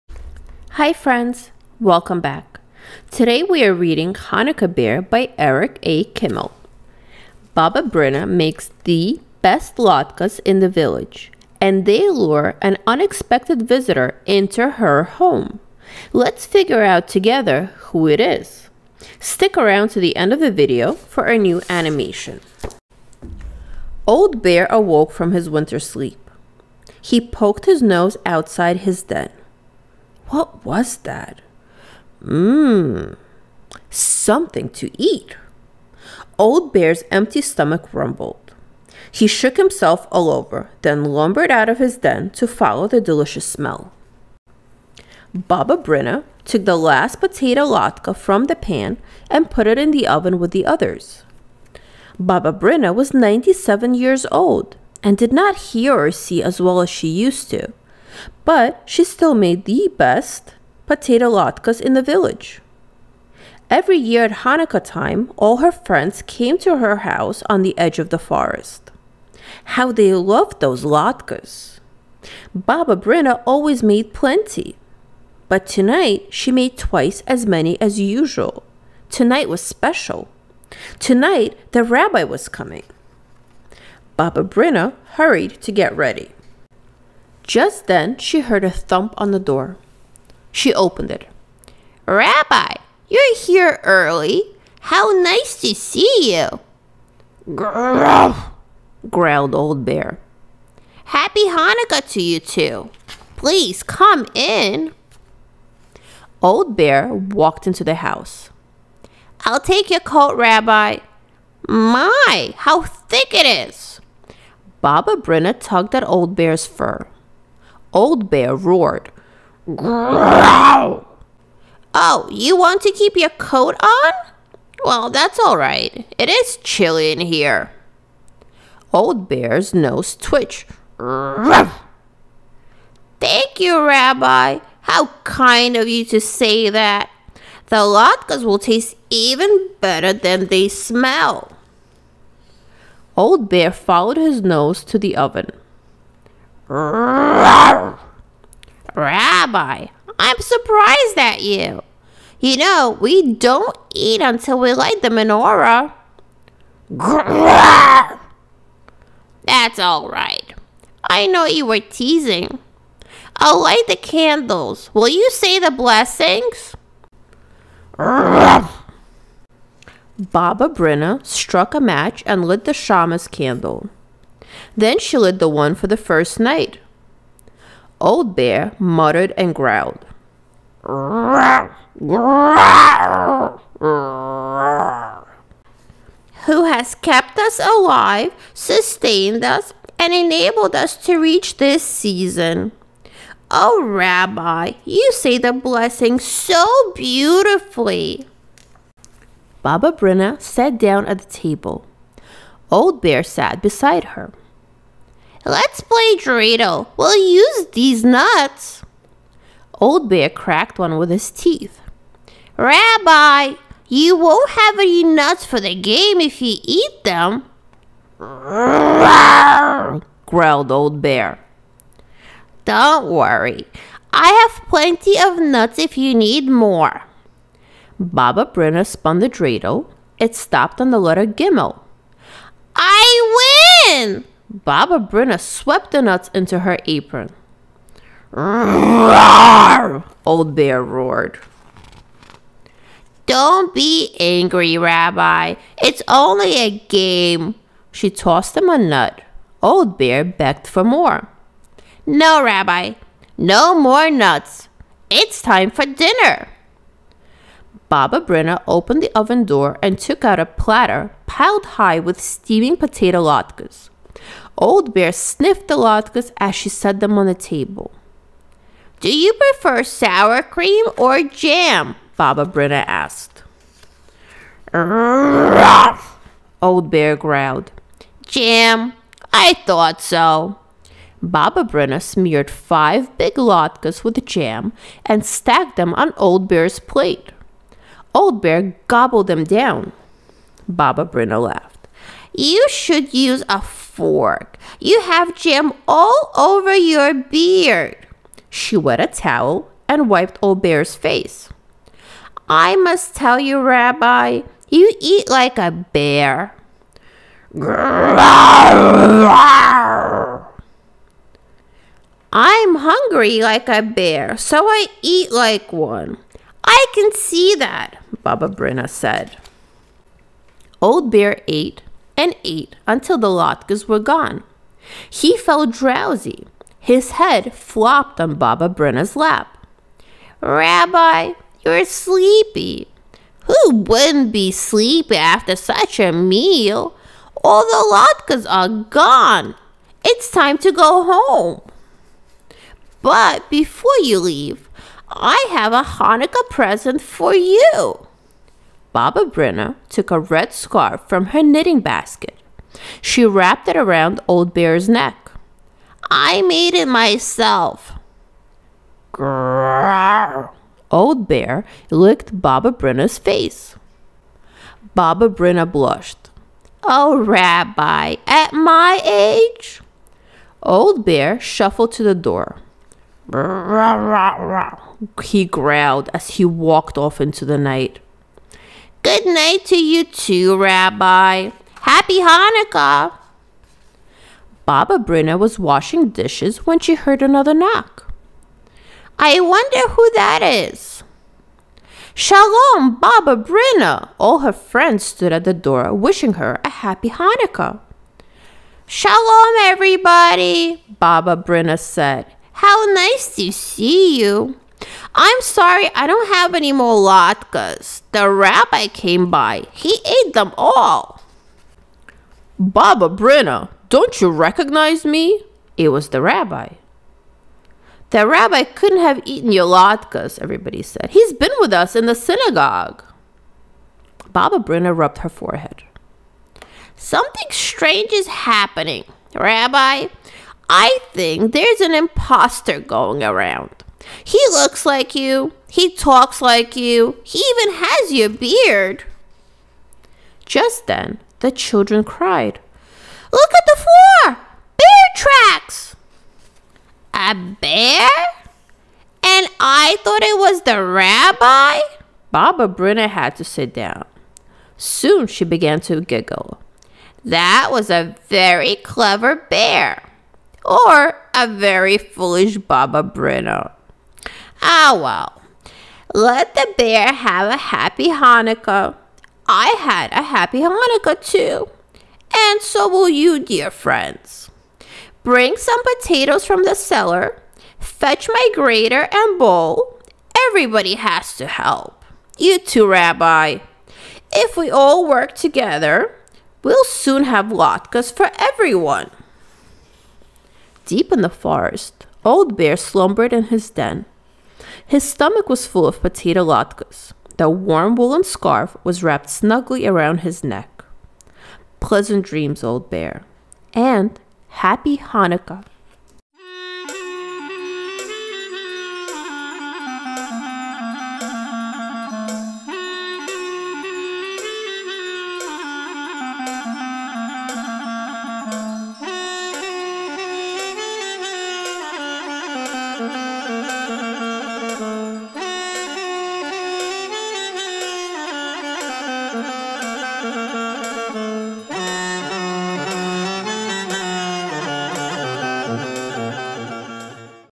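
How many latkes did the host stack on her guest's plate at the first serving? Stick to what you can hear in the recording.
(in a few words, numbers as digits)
5.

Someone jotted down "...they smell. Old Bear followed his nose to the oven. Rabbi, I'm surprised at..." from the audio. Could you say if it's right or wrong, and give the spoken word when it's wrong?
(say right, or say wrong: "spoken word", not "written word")
right.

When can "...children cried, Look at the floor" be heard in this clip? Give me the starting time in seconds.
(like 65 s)
441 s.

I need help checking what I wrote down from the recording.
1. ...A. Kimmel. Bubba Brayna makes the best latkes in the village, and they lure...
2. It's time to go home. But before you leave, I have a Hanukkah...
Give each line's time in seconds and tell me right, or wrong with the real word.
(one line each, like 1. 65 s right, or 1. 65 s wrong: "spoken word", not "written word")
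1. 5 s right
2. 340 s right.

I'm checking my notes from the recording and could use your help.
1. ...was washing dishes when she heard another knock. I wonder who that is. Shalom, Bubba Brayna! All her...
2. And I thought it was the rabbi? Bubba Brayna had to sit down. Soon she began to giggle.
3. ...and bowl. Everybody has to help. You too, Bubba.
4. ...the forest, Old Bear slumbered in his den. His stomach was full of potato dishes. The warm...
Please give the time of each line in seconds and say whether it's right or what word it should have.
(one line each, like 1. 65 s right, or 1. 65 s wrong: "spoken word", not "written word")
1. 385 s right
2. 449 s right
3. 479 s wrong: "Rabbi", not "Bubba"
4. 491 s wrong: "latkes", not "dishes".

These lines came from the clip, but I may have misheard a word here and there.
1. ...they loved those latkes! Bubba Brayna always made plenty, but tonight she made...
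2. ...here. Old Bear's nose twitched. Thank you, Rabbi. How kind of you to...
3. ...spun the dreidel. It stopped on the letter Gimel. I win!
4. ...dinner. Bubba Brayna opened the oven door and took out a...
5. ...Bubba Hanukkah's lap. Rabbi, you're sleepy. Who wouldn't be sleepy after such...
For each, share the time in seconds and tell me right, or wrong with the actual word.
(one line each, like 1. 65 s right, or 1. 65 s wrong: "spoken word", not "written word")
1. 69 s right
2. 127 s right
3. 228 s right
4. 255 s right
5. 328 s wrong: "Brayna", not "Hanukkah".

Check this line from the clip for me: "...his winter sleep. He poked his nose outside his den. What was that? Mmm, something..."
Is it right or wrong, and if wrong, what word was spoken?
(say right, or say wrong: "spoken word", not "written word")
right.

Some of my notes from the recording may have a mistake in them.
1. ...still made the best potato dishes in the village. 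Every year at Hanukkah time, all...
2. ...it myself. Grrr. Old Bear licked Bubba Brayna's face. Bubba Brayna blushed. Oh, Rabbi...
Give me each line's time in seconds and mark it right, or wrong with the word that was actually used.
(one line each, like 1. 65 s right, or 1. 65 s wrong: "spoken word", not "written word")
1. 59 s wrong: "latkes", not "dishes"
2. 356 s right.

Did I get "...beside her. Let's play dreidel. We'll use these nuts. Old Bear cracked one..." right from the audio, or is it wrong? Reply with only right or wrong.
right.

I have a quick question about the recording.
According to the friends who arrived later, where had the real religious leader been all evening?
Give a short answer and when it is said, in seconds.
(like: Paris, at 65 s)
the synagogue, at 421 s.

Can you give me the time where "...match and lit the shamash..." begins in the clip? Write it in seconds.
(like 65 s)
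171 s.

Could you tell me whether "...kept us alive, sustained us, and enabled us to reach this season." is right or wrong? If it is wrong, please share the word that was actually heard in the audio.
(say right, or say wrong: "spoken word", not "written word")
right.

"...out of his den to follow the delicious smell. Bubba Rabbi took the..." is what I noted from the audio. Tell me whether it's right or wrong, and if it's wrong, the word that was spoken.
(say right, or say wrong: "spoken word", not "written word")
wrong: "Brayna", not "Rabbi".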